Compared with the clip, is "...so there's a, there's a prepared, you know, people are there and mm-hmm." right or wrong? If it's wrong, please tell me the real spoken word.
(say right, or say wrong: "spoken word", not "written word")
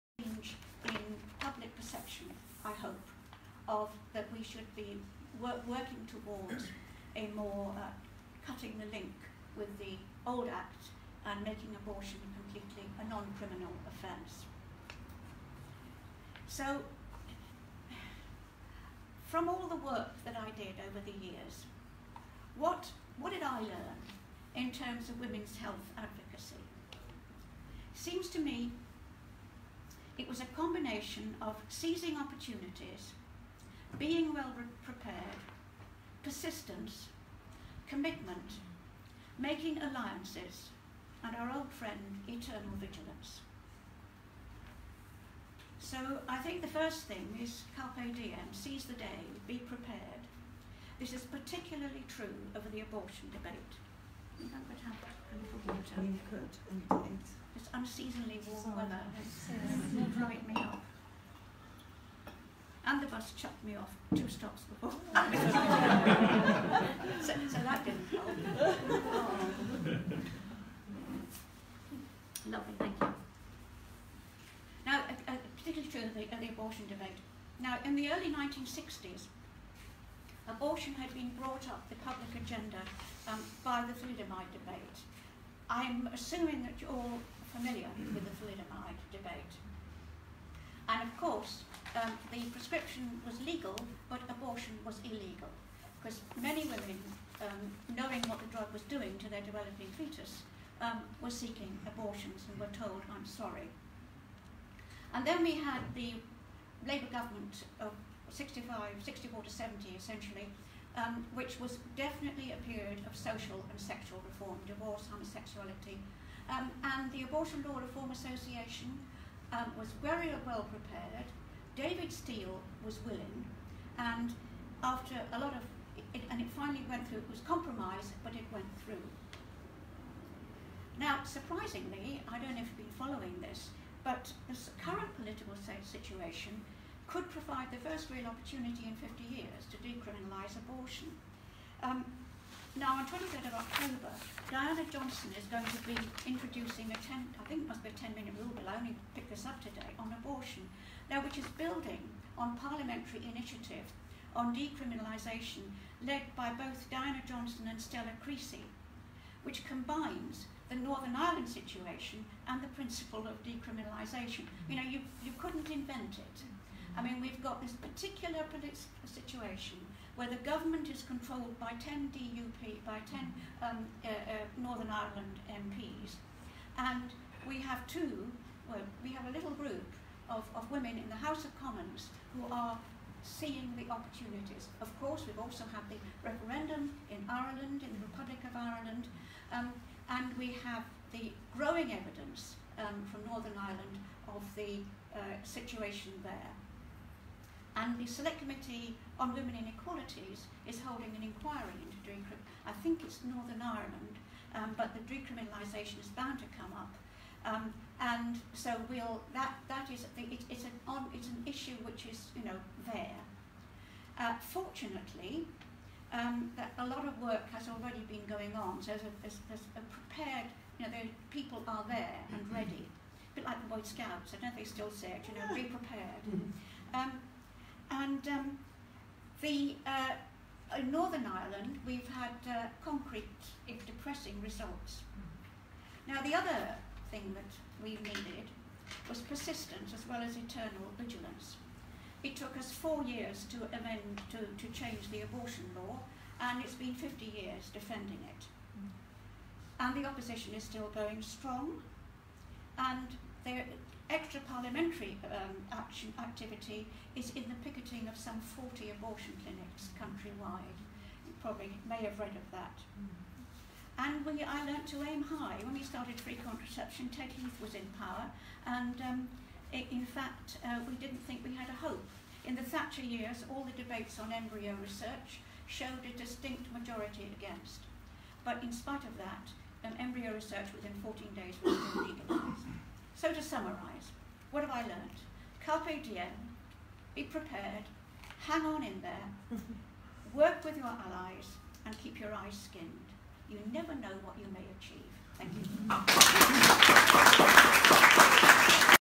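right.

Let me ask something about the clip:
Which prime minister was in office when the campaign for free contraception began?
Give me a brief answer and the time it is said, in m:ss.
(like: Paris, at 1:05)
Ted Heath, at 4:27.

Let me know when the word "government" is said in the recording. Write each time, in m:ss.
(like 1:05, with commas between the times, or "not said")
1:47, 2:50.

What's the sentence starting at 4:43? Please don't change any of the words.
So to summarise, what have I learnt?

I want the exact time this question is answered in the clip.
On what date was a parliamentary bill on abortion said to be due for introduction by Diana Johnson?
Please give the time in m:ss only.
2:23.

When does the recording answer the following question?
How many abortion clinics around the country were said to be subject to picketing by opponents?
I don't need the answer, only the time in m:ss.
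4:18.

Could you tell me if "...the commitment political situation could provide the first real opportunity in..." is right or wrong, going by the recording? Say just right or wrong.
wrong.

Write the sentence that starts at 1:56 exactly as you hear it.
Um, and the Abortion Law Reform Association um, was very well prepared.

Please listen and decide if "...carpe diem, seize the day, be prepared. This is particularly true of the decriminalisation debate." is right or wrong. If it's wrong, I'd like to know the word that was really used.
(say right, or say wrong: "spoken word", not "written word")
wrong: "abortion", not "decriminalisation".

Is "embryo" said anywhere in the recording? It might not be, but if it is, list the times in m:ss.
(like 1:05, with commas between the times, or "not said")
4:34, 4:39.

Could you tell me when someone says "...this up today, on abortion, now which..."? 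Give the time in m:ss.
2:29.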